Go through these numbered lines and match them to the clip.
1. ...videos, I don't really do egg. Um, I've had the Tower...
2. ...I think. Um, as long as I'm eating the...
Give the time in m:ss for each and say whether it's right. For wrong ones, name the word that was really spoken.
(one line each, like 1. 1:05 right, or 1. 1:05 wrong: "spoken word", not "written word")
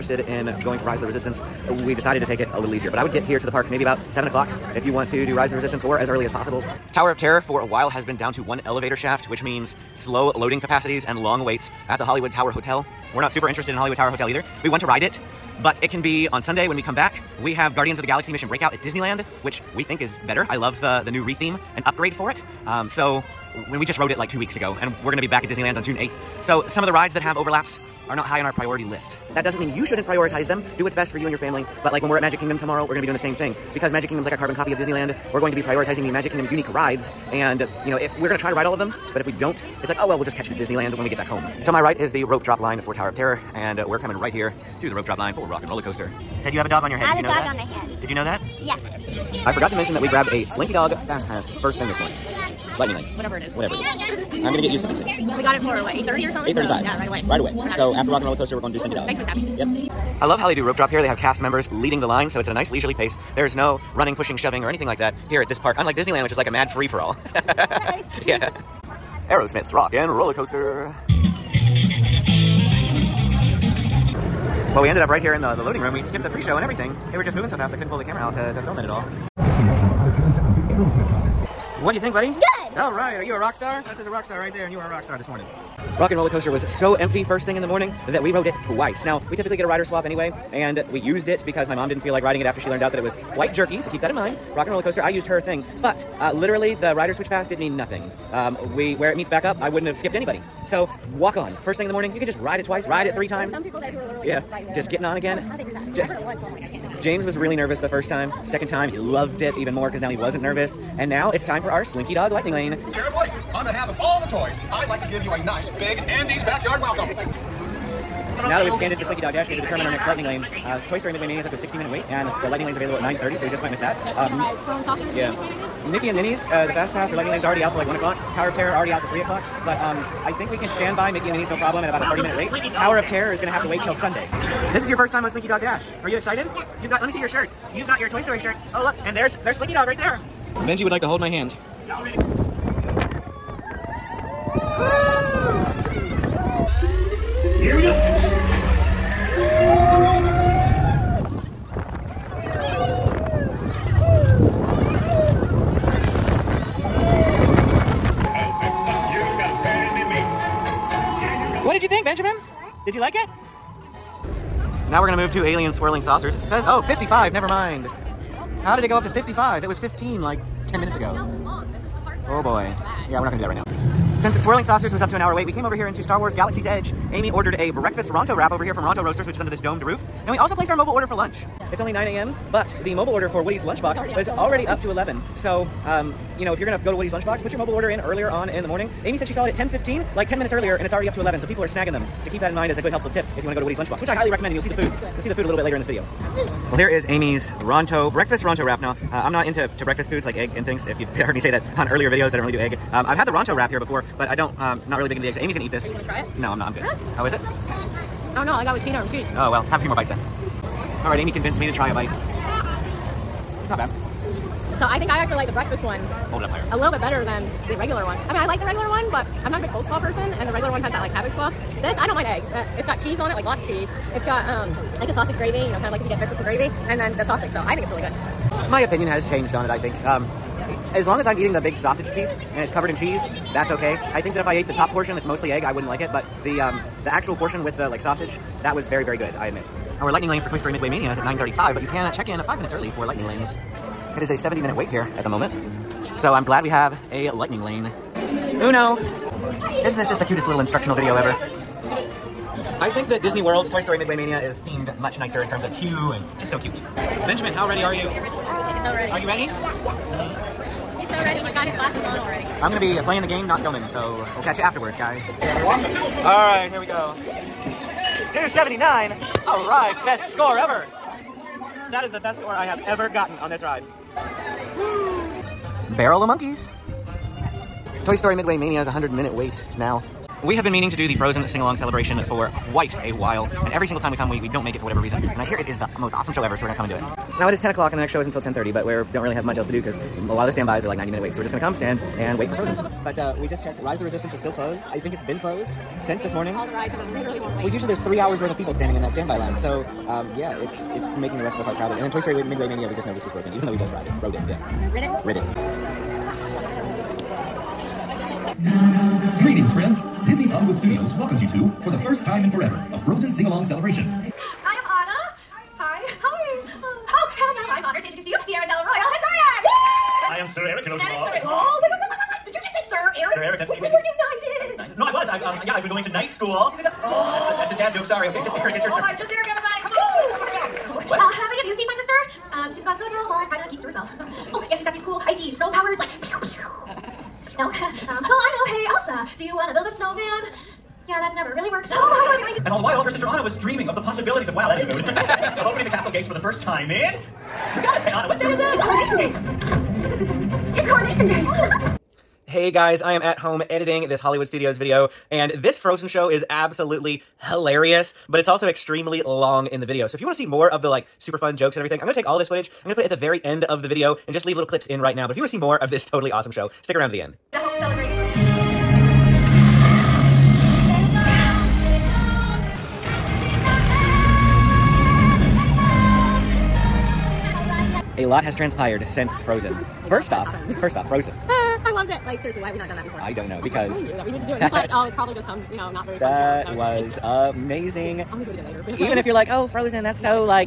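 1. 3:22 wrong: "Ronto", not "Tower"
2. 3:49 right.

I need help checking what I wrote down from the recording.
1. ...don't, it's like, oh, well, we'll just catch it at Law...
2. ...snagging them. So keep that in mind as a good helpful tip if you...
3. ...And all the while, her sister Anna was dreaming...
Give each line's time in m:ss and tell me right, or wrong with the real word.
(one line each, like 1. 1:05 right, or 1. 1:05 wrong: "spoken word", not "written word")
1. 0:39 wrong: "Disneyland", not "Law"
2. 3:11 right
3. 5:42 right.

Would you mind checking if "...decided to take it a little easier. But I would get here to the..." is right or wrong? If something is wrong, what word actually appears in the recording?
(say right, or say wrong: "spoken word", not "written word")
right.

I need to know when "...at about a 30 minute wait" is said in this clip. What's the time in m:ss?
2:11.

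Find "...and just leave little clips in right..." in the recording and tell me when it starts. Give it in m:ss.
6:04.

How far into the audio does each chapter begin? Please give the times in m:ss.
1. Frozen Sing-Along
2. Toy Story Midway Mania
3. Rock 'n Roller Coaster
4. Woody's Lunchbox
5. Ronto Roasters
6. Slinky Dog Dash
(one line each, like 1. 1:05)
1. 4:39
2. 3:59
3. 1:08
4. 6:17
5. 2:53
6. 1:52.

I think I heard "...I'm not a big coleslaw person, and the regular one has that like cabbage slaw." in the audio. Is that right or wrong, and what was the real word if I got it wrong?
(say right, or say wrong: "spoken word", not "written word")
right.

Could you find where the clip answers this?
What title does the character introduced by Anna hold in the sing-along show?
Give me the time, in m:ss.
5:18.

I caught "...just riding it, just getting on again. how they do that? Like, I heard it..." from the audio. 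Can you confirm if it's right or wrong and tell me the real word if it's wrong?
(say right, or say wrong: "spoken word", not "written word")
right.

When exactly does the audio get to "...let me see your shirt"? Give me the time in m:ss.
2:17.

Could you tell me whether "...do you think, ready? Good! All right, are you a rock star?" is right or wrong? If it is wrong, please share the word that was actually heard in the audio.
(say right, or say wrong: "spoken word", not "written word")
wrong: "buddy", not "ready".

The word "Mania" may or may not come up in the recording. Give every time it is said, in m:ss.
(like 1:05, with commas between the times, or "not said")
2:01, 4:00, 4:14, 4:38, 5:02.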